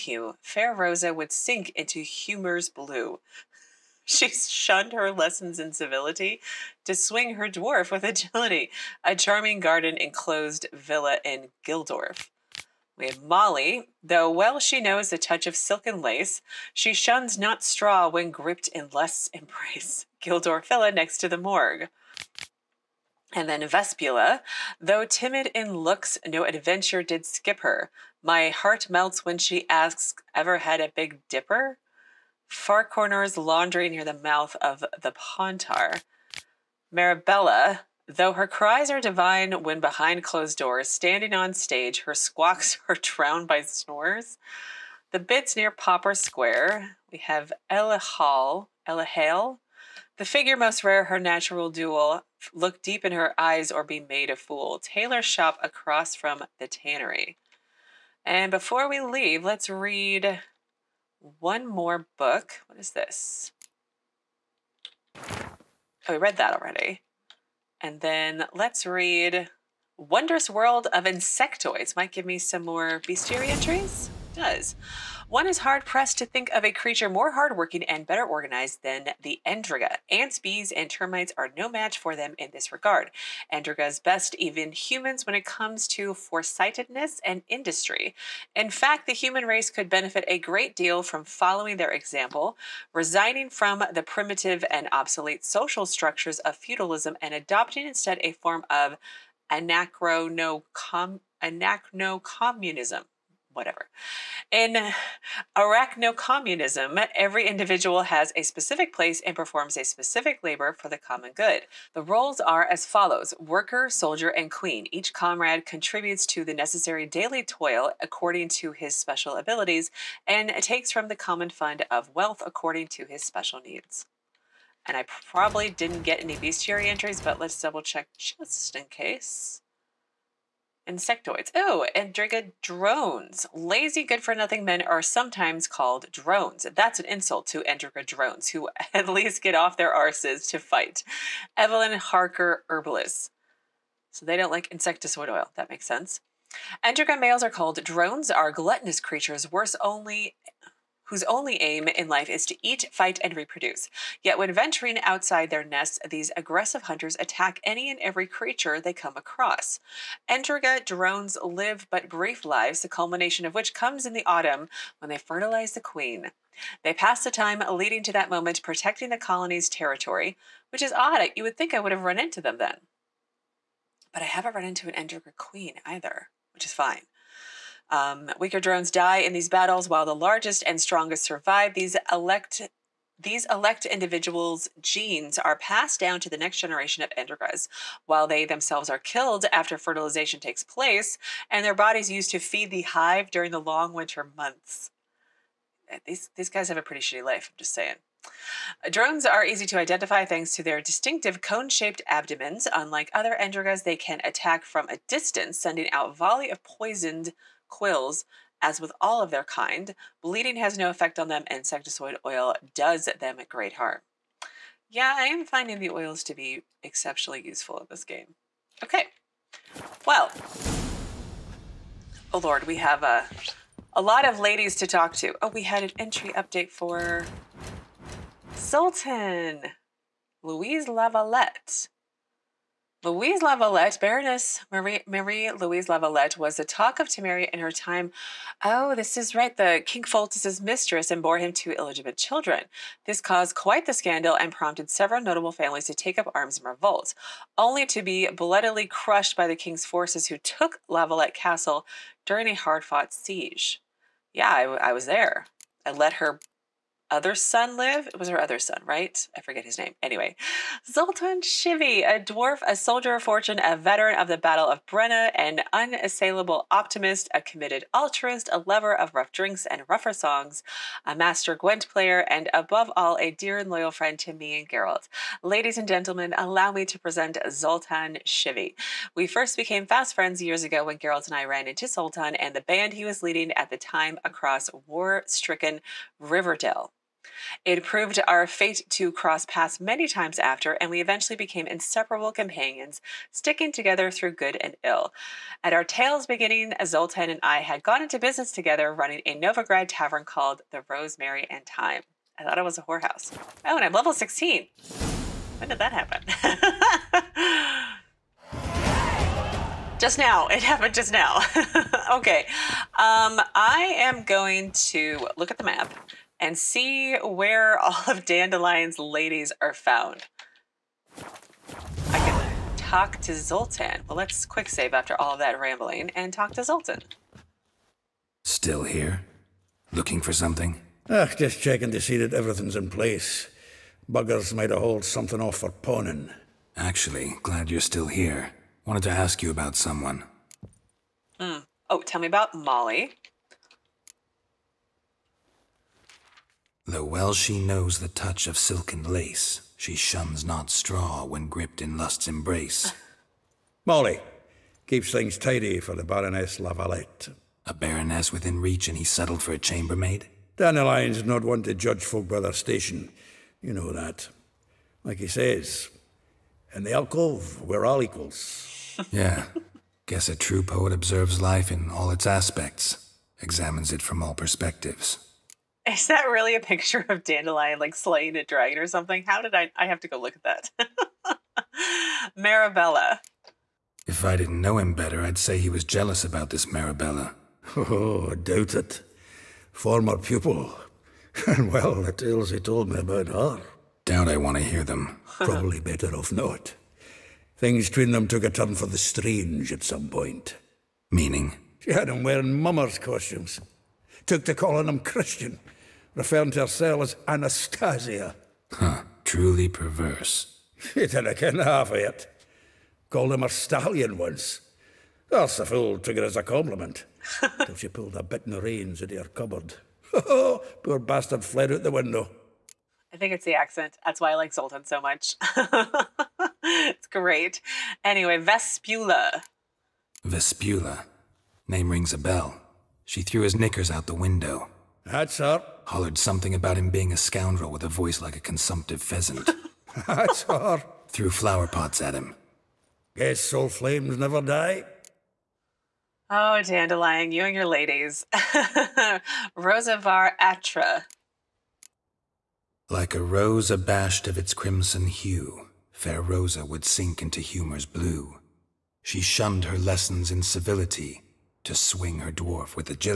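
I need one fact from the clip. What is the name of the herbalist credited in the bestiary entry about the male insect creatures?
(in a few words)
Evelyn Harker.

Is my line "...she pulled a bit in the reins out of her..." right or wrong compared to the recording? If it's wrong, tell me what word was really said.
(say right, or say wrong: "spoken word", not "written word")
right.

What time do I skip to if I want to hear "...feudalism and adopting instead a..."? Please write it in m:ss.
1:36.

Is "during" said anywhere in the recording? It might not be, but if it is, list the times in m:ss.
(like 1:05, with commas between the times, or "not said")
3:13, 4:12.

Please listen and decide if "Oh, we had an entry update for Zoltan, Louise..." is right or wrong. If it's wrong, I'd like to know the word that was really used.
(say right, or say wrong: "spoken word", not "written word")
right.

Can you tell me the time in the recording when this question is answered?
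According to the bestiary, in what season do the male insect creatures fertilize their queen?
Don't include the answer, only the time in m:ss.
2:44.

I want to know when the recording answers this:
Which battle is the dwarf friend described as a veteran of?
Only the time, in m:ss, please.
4:24.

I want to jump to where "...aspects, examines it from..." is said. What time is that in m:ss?
6:12.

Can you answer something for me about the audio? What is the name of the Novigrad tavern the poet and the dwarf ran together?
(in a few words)
Rosemary and Thyme.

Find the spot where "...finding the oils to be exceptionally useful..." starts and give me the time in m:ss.
3:35.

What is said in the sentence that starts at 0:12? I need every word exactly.
We have Molly, though well she knows the touch of silk and lace, she shuns not straw when gripped in lust's embrace.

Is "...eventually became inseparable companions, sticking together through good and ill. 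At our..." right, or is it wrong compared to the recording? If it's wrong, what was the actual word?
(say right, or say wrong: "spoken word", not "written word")
right.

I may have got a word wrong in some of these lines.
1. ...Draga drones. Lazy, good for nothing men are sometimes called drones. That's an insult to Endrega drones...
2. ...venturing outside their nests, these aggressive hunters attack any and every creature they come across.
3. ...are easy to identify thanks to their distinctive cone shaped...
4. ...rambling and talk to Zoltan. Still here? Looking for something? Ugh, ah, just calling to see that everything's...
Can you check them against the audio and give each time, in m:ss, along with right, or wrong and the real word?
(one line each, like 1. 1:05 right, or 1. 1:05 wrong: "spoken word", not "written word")
1. 2:12 right
2. 2:34 right
3. 3:19 right
4. 5:25 wrong: "checking", not "calling".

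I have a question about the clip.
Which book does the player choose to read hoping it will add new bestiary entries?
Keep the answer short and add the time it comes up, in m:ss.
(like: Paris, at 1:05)
Wondrous World of Insectoids, at 1:09.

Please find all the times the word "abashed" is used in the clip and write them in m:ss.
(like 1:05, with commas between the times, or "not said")
7:33.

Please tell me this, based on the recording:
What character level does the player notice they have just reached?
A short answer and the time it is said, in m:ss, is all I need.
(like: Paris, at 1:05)
16, at 5:04.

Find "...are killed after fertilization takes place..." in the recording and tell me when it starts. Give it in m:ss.
3:08.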